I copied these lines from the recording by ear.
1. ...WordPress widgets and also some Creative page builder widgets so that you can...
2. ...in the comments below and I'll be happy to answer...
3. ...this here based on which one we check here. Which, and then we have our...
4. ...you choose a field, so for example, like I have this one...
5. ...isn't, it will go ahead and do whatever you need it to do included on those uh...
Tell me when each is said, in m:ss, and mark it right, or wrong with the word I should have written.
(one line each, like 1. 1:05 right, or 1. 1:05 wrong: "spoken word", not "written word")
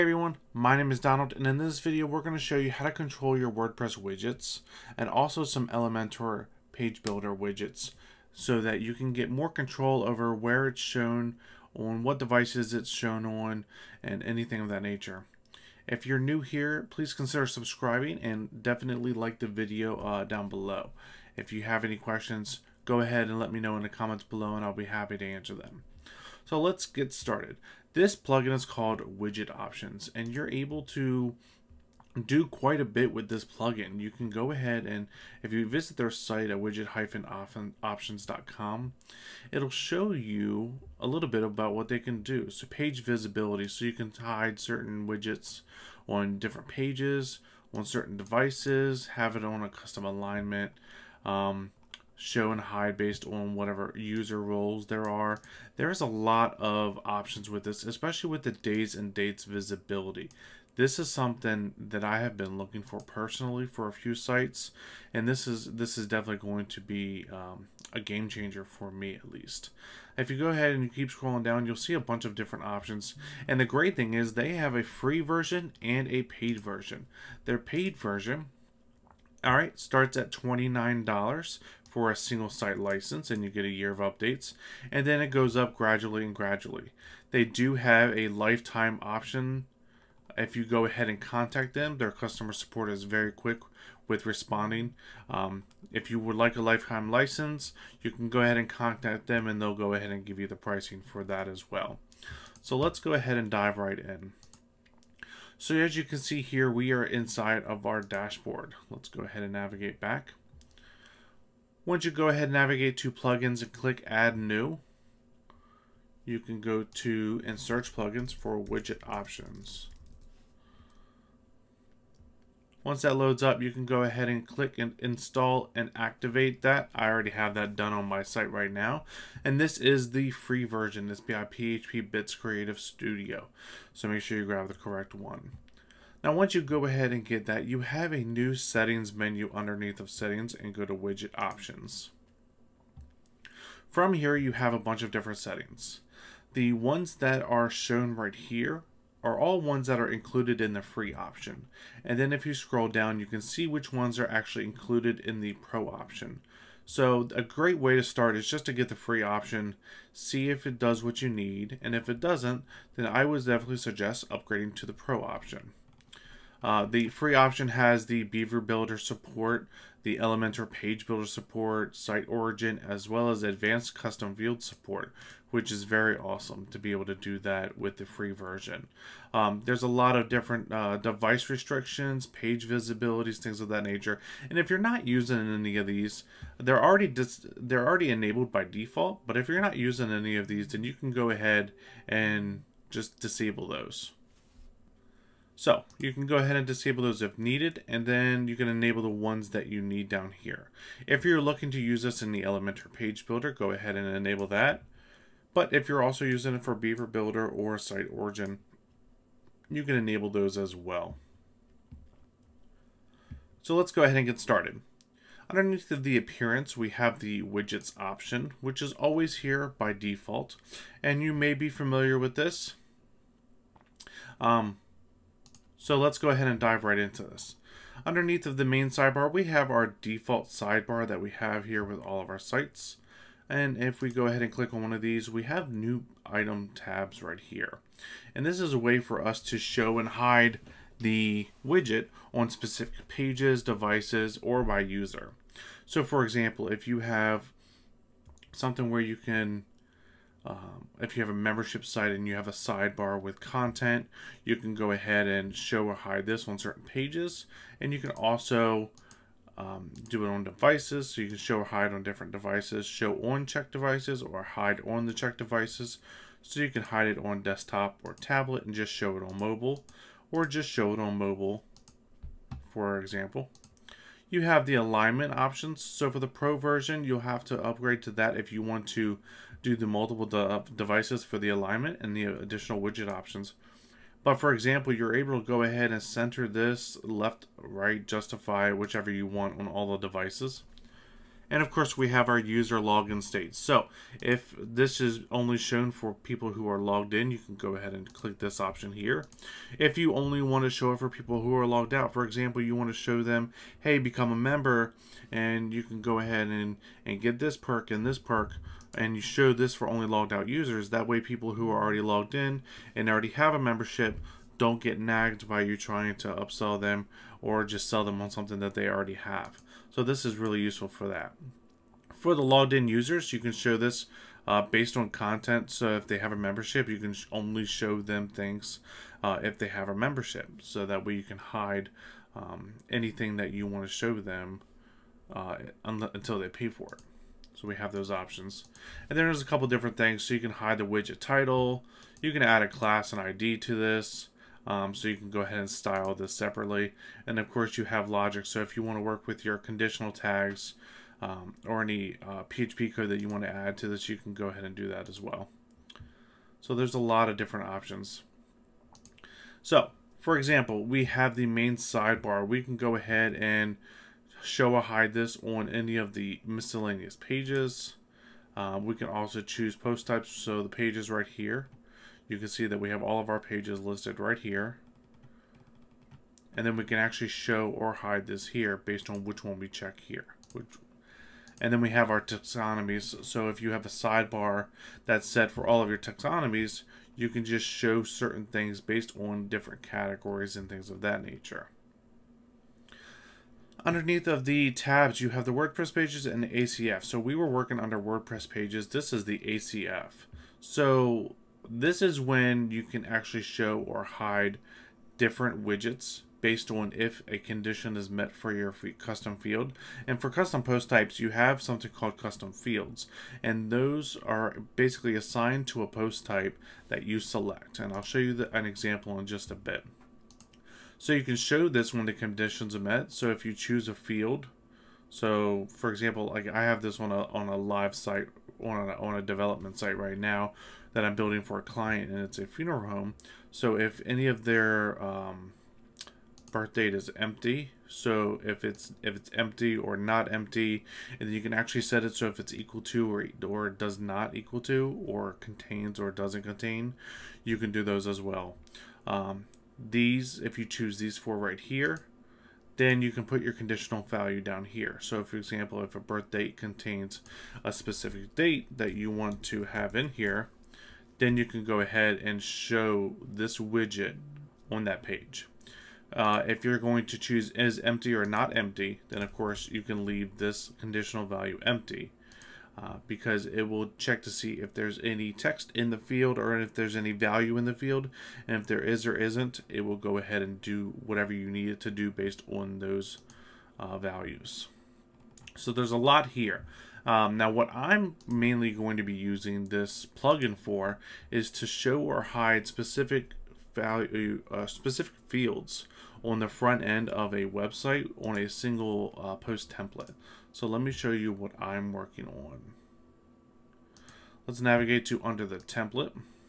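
1. 0:03 wrong: "Elementor", not "Creative"
2. 0:23 right
3. 6:18 right
4. 7:03 right
5. 7:59 wrong: "based", not "included".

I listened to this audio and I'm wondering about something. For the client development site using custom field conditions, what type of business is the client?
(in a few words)
funeral home.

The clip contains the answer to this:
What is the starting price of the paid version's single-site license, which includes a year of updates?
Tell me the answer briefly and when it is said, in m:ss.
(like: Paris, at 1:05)
$29, at 1:20.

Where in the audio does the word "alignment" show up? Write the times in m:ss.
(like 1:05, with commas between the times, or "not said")
0:50, 4:34, 4:41.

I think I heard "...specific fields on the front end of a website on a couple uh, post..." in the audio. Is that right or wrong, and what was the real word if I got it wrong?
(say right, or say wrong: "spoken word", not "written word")
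wrong: "single", not "couple".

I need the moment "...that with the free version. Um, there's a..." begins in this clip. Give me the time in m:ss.
2:57.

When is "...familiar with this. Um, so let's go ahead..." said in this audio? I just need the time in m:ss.
3:41.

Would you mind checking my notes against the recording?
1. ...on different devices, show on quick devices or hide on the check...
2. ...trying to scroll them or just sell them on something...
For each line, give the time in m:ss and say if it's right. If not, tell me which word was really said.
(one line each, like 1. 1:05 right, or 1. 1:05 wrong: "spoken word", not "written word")
1. 4:21 wrong: "check", not "quick"
2. 5:15 wrong: "upsell", not "scroll".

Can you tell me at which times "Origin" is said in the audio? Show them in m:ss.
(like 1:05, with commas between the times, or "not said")
2:52, 3:28.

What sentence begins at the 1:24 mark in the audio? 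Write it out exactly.
And then it goes up gradually and gradually.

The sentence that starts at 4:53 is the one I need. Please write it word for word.
So if this is only shown for people who are logged in, you can go ahead and click this option here.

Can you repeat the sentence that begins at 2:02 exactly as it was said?
Once that loads up, you can go ahead and click and install and activate that.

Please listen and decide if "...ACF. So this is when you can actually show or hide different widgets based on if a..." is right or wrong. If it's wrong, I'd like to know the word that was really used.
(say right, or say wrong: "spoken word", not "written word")
right.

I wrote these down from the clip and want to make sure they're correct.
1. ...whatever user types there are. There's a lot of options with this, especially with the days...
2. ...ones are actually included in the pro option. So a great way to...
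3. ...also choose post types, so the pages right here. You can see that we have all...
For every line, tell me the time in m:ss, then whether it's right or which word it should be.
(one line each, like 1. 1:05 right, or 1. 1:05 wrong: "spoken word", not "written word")
1. 0:53 wrong: "roles", not "types"
2. 2:33 right
3. 6:09 right.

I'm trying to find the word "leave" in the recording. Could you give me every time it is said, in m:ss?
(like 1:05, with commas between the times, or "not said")
7:50.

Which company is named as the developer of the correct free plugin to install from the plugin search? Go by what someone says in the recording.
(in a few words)
PHP Bits Creative Studio.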